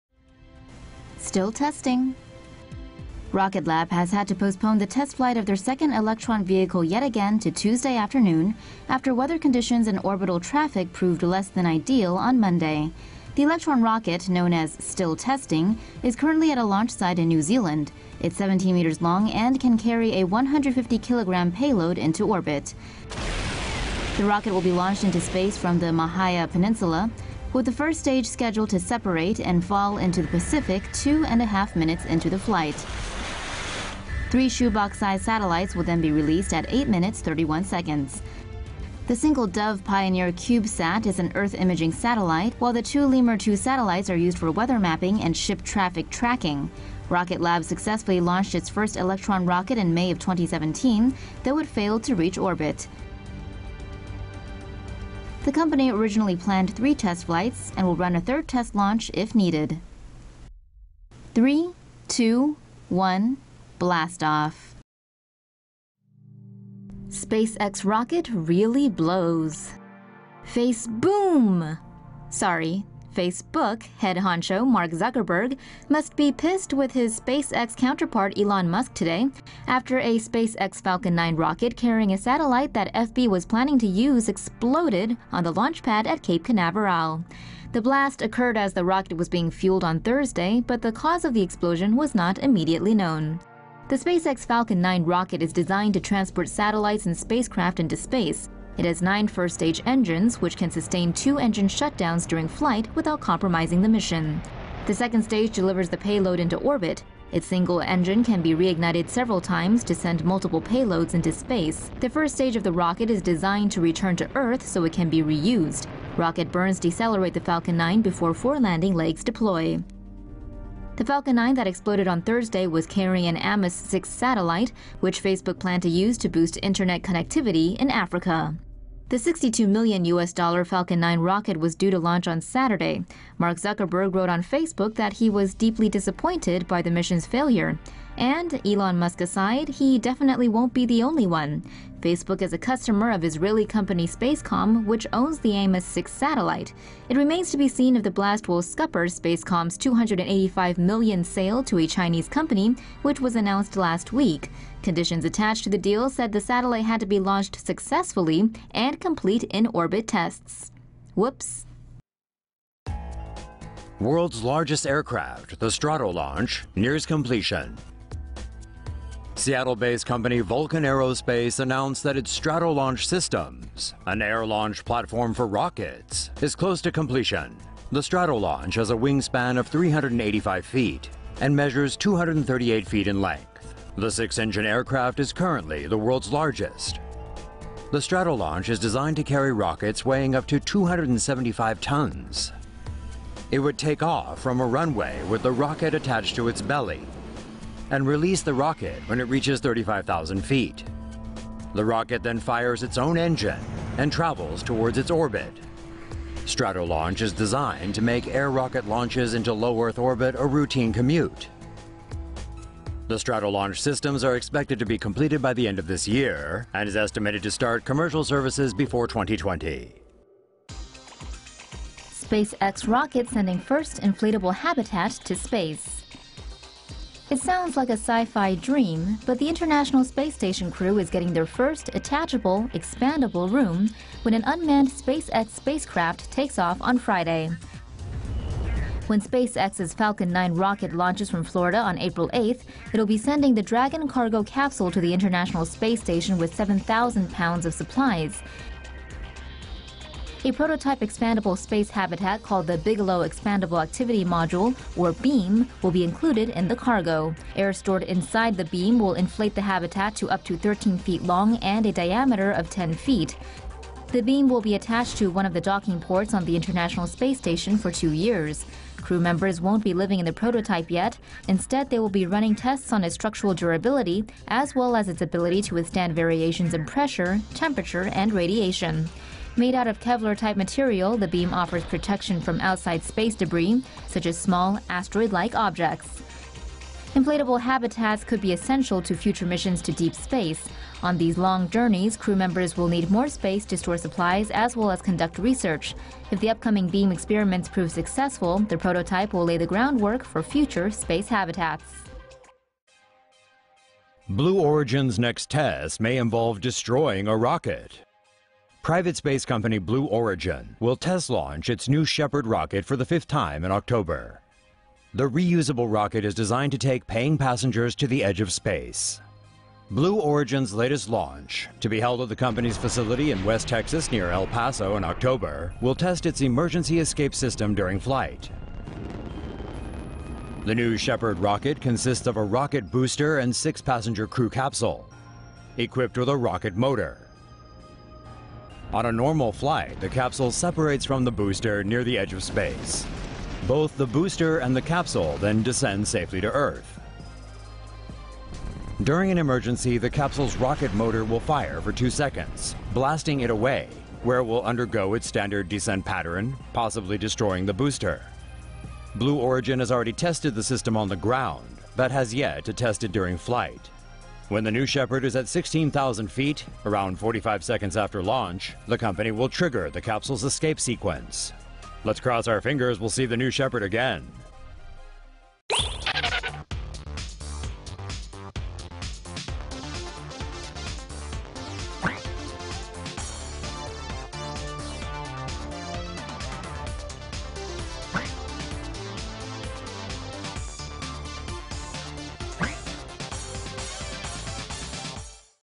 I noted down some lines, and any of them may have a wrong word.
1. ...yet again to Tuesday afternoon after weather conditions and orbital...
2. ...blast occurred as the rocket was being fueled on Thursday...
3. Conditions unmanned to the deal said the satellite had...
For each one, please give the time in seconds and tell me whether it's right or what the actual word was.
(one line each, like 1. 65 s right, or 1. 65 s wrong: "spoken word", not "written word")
1. 6 s right
2. 87 s right
3. 154 s wrong: "attached", not "unmanned".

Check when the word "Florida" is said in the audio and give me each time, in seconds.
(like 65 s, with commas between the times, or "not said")
241 s.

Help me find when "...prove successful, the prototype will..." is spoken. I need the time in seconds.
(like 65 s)
297 s.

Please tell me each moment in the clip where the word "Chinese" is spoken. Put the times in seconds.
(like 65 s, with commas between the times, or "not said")
151 s.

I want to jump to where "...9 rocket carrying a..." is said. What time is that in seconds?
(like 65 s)
81 s.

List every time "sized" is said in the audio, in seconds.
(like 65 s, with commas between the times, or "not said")
34 s.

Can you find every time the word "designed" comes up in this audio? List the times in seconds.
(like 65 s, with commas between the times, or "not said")
95 s, 113 s, 188 s, 207 s, 316 s.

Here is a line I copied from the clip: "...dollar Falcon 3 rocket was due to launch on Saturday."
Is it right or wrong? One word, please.
wrong.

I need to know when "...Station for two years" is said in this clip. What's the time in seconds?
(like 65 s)
267 s.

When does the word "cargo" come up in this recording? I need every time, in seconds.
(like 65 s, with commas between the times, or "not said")
244 s, 256 s.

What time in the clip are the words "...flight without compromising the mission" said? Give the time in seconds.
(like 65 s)
102 s.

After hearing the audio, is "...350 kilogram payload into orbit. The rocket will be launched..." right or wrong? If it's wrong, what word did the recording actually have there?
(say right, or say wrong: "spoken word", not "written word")
wrong: "150", not "350".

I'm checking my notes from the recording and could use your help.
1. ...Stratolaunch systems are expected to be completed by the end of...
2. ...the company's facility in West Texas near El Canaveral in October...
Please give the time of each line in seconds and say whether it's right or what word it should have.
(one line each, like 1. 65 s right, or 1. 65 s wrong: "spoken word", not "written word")
1. 213 s right
2. 322 s wrong: "Paso", not "Canaveral".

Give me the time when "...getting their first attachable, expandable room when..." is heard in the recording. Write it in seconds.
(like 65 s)
231 s.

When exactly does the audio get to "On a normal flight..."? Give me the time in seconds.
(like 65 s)
338 s.